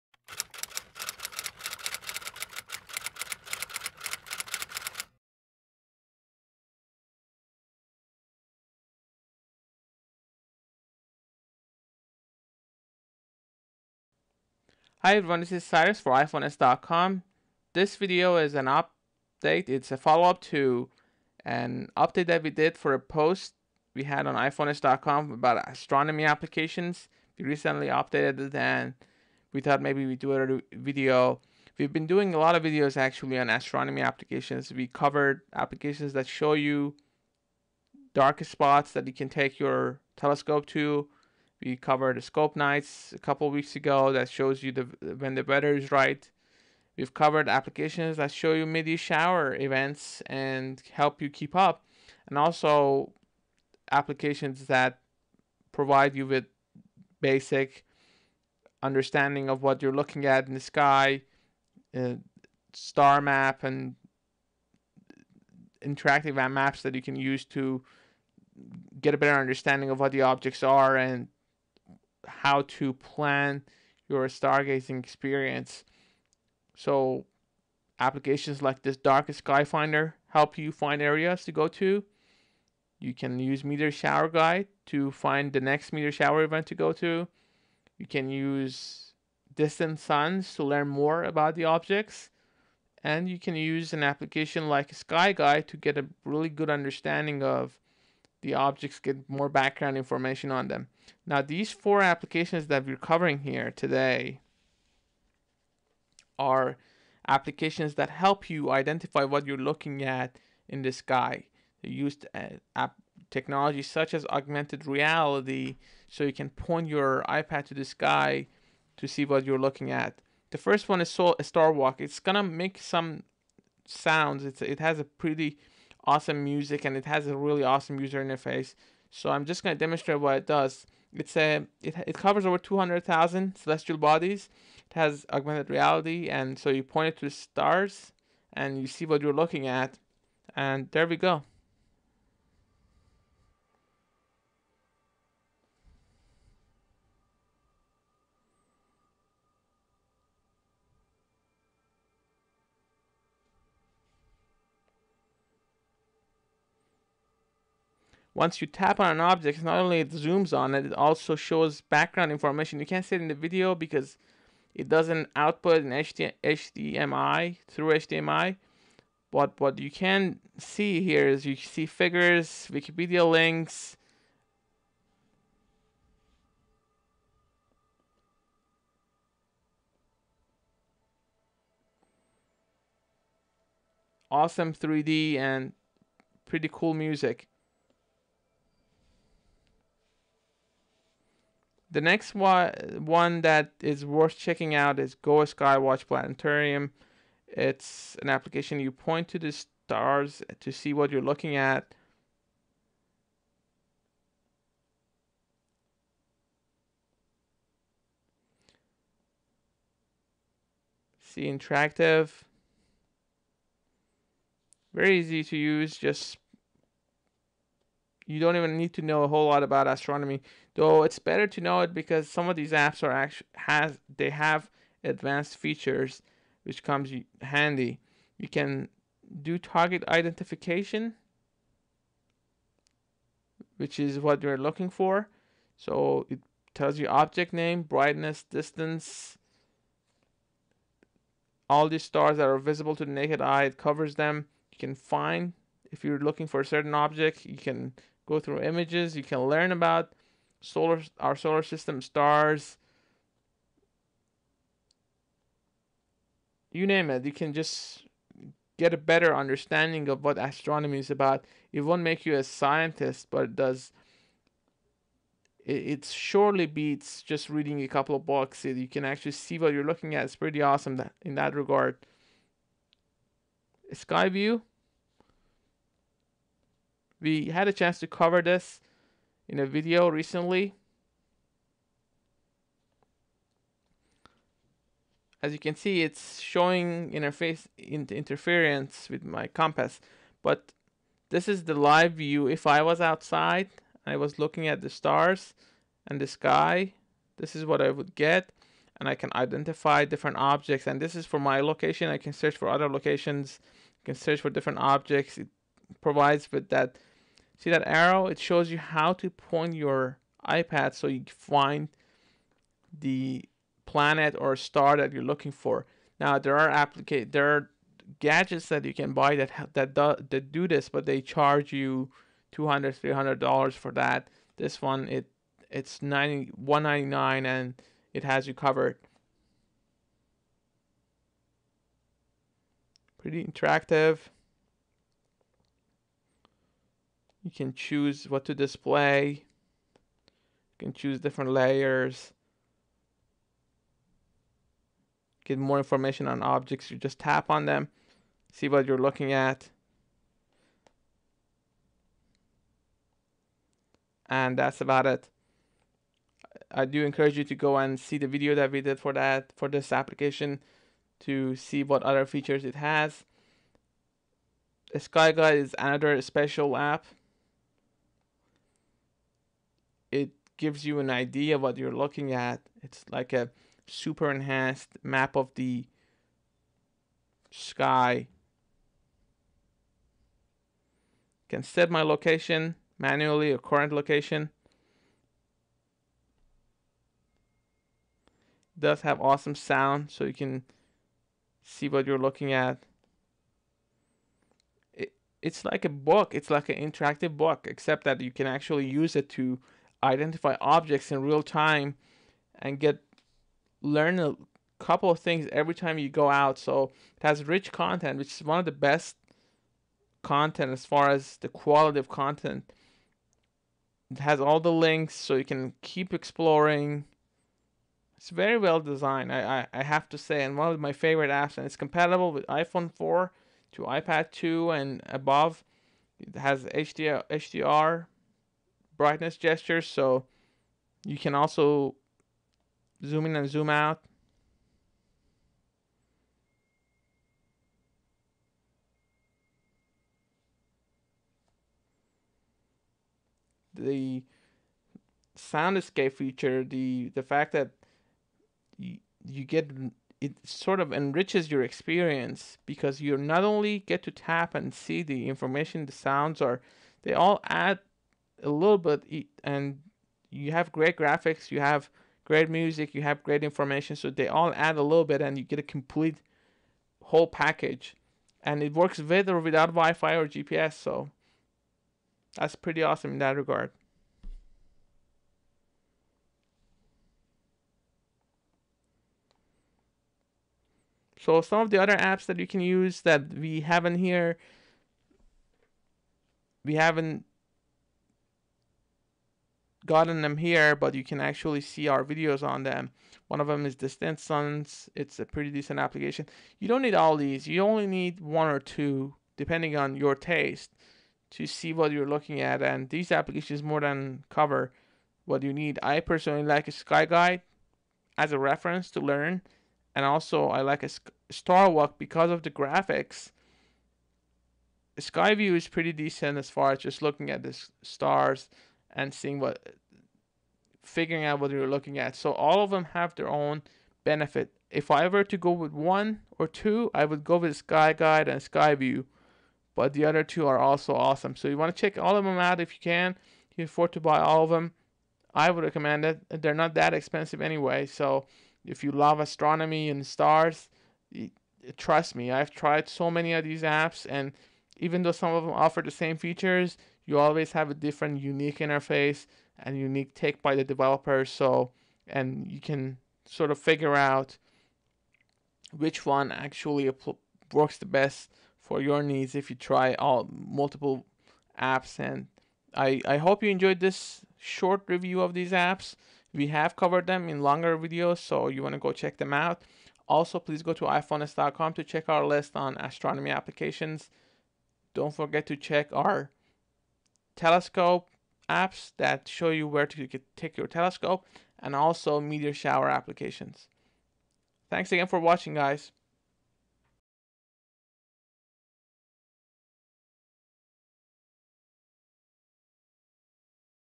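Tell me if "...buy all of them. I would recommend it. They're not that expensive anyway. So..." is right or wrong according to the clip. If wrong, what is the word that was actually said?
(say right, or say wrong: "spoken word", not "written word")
right.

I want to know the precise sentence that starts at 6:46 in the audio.
So it has rich content, which is one of the best content as far as the quality of content.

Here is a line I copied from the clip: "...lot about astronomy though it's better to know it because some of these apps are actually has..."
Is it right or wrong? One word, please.
right.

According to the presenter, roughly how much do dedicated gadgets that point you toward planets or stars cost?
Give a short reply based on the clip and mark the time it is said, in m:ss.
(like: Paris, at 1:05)
200 to 300 dollars, at 5:22.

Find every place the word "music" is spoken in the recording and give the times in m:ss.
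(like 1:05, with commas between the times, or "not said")
2:06, 3:06, 7:42.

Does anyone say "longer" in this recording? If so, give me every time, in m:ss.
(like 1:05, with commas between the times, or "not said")
9:27.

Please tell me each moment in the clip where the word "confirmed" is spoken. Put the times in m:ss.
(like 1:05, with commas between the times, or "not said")
not said.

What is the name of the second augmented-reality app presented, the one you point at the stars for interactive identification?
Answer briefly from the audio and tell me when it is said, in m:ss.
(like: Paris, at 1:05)
Go Skywatch Planetarium, at 3:15.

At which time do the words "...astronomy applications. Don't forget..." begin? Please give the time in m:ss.
9:32.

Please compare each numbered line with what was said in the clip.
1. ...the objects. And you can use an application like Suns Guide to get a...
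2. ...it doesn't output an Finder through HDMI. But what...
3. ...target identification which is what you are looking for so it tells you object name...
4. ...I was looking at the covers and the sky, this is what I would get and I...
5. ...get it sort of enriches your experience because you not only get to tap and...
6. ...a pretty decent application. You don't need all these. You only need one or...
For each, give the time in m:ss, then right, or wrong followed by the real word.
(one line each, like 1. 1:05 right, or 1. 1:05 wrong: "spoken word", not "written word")
1. 1:31 wrong: "Sky", not "Suns"
2. 2:44 wrong: "HDMI", not "Finder"
3. 3:49 right
4. 4:54 wrong: "stars", not "covers"
5. 7:29 right
6. 8:15 right.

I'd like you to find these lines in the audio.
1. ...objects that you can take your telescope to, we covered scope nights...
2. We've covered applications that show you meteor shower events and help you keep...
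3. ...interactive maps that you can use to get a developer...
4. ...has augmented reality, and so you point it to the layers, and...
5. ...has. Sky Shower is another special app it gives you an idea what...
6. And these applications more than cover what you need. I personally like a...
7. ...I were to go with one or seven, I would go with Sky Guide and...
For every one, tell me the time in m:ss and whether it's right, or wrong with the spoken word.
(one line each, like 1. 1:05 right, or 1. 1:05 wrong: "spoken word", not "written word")
1. 0:38 wrong: "spots", not "objects"
2. 0:46 right
3. 1:05 wrong: "better", not "developer"
4. 2:14 wrong: "stars", not "layers"
5. 6:02 wrong: "Guide", not "Shower"
6. 8:22 right
7. 8:44 wrong: "two", not "seven".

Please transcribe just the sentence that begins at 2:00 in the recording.
The first one is Sol- Star Walk.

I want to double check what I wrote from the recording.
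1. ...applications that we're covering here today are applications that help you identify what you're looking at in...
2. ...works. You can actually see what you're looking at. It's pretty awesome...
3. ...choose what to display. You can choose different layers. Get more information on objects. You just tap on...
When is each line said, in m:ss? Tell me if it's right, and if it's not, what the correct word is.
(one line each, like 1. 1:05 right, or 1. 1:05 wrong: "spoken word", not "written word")
1. 1:42 right
2. 4:28 wrong: "books", not "works"
3. 5:37 right.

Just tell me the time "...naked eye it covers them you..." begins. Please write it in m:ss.
4:03.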